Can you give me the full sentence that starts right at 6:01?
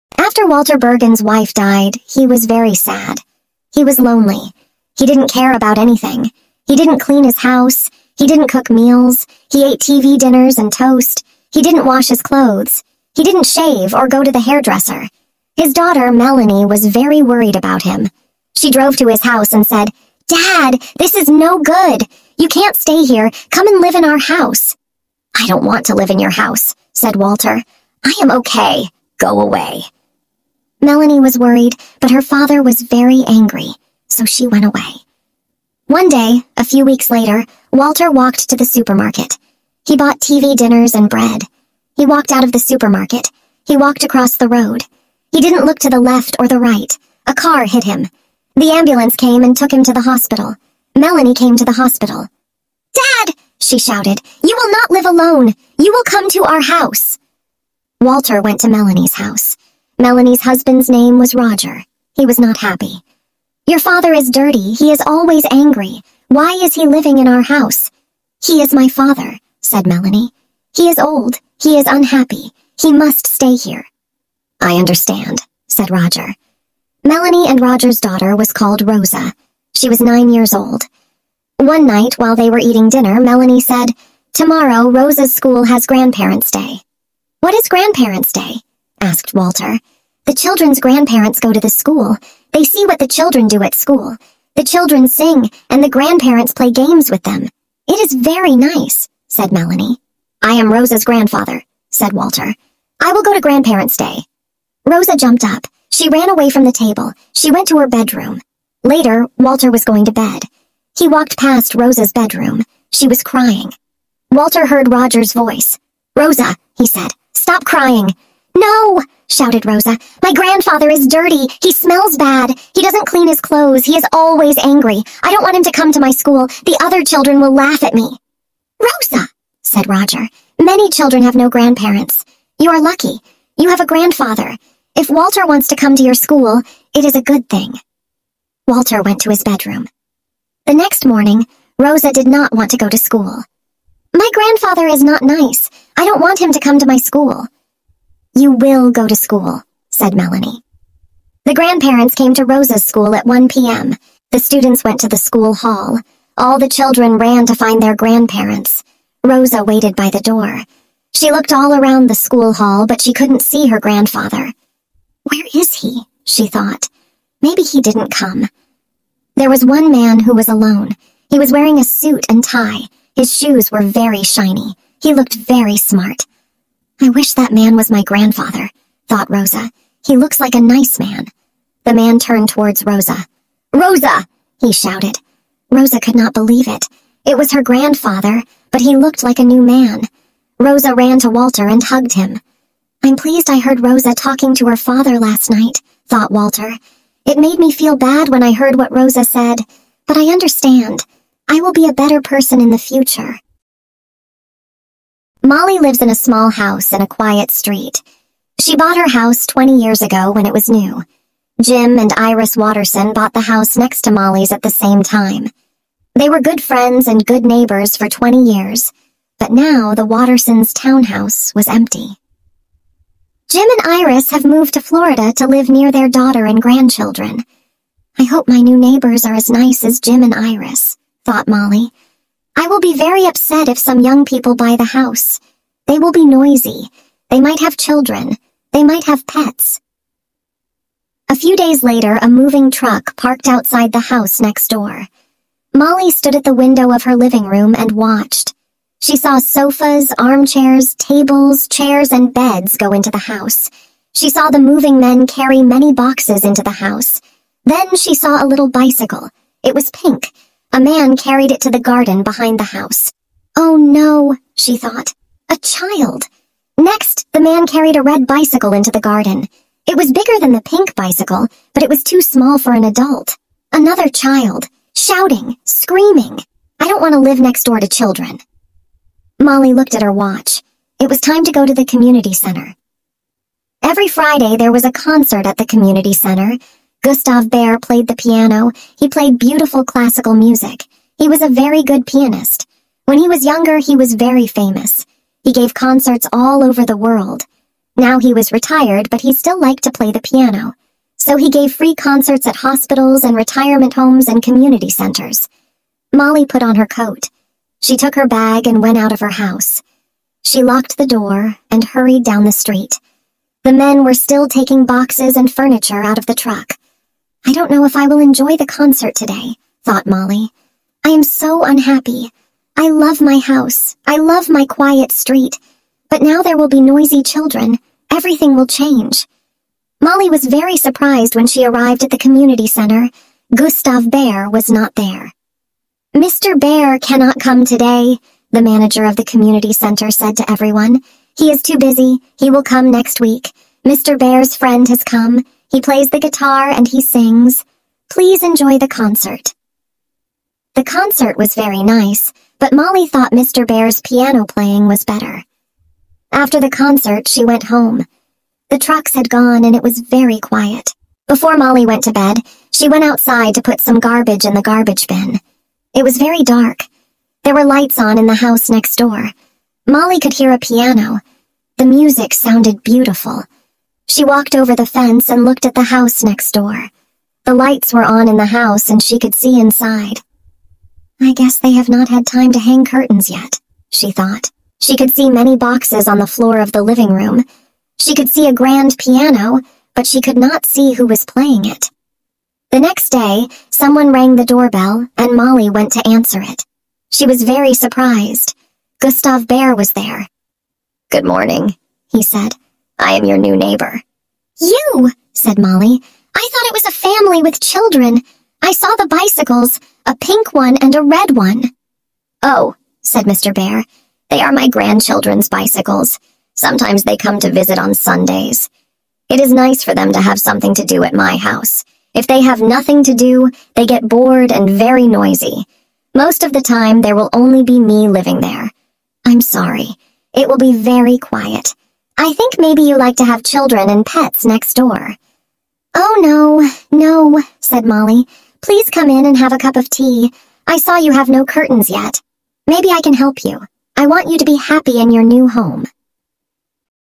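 Before Molly went to bed, she went outside to put some garbage in the garbage bin.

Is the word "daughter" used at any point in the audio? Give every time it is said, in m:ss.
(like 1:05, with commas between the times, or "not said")
0:15, 1:18, 3:46.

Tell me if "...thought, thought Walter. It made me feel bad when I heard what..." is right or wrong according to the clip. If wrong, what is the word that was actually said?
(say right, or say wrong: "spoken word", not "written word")
wrong: "night", not "thought".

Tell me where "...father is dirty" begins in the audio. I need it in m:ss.
1:03.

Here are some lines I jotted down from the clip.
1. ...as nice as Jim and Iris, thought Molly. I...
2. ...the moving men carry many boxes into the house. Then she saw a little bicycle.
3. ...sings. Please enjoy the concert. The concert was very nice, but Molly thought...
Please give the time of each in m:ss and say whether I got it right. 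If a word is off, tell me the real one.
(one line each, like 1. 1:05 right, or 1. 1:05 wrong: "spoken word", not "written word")
1. 3:49 right
2. 4:14 right
3. 5:47 right.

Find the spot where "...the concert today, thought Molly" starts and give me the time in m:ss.
5:18.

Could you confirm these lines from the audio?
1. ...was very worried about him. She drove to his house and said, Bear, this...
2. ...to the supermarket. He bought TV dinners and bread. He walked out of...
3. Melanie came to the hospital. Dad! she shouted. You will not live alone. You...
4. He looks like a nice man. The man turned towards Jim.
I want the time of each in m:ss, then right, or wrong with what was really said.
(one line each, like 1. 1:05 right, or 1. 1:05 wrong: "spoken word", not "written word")
1. 0:16 wrong: "Dad", not "Bear"
2. 0:38 right
3. 0:50 right
4. 3:00 wrong: "Rosa", not "Jim".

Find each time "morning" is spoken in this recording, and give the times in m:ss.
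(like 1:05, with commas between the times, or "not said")
2:21, 6:41.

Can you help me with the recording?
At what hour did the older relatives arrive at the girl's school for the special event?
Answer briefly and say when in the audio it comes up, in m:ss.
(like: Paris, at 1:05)
1 p.m., at 2:33.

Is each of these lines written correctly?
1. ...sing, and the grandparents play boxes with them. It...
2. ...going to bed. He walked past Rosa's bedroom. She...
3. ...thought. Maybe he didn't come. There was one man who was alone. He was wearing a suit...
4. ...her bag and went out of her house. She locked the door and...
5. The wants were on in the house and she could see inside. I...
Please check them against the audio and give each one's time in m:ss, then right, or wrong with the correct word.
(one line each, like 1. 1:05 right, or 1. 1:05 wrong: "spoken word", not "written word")
1. 1:35 wrong: "games", not "boxes"
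2. 1:49 right
3. 2:46 right
4. 5:08 right
5. 6:17 wrong: "lights", not "wants".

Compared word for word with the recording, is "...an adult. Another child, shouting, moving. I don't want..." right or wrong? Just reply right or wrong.
wrong.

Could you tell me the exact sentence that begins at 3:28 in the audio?
She bought her house 20 years ago when it was new.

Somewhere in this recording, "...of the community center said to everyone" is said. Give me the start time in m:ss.
5:39.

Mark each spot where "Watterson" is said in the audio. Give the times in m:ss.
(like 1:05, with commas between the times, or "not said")
3:32, 3:40.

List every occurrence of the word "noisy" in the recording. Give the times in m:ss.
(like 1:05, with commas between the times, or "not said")
3:56, 5:26, 7:05.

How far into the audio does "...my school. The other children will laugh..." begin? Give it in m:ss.
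2:05.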